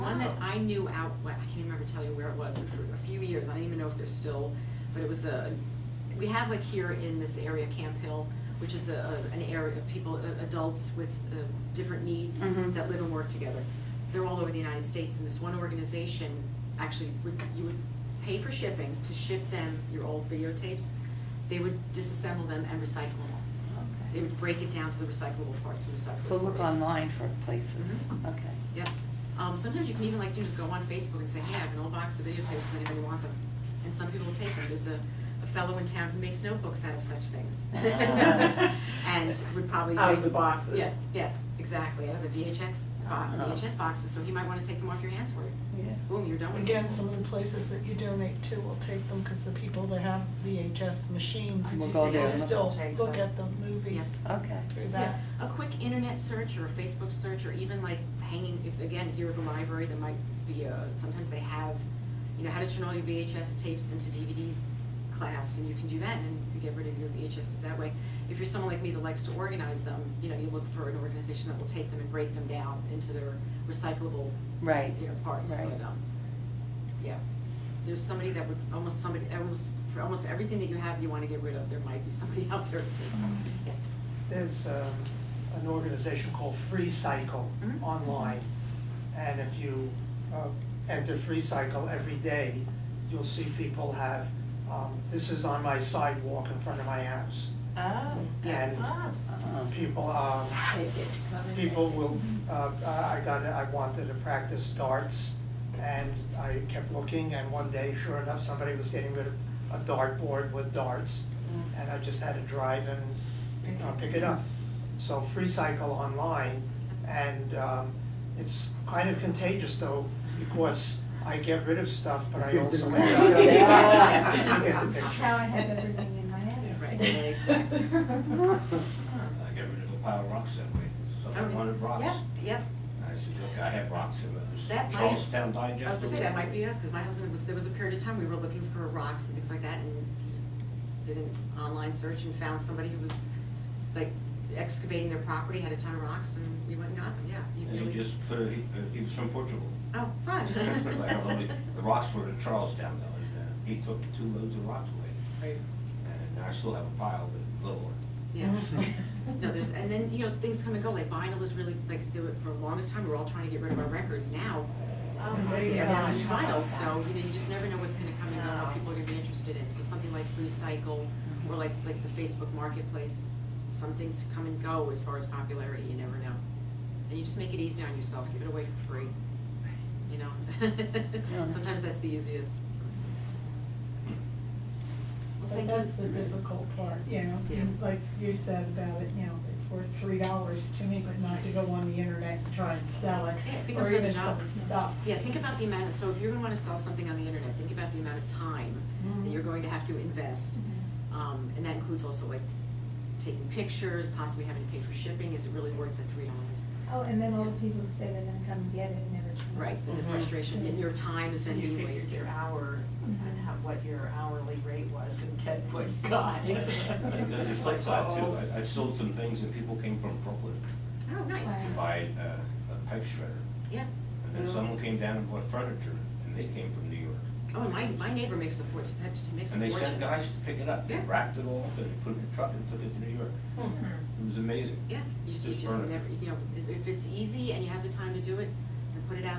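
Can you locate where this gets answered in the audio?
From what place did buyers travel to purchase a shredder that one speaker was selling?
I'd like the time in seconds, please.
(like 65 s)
220 s.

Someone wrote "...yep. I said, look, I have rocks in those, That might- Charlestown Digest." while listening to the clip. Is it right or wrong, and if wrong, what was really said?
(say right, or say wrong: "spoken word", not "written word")
right.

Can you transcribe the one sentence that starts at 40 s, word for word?
Yeah, yes, exactly, out of the VHX, bo- uh-huh.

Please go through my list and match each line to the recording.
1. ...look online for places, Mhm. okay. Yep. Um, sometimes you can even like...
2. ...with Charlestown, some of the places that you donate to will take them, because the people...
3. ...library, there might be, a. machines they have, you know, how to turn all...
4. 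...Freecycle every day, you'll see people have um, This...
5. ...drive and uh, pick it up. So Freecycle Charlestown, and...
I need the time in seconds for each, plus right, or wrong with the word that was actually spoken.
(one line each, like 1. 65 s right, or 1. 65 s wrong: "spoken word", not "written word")
1. 26 s right
2. 46 s wrong: "Again", not "Charlestown"
3. 59 s wrong: "sometimes", not "machines"
4. 91 s right
5. 112 s wrong: "Online", not "Charlestown".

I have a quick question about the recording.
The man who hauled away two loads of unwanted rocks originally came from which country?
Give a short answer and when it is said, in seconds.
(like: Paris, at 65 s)
Portugal, at 149 s.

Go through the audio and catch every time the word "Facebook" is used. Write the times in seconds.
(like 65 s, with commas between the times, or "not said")
30 s, 56 s, 172 s.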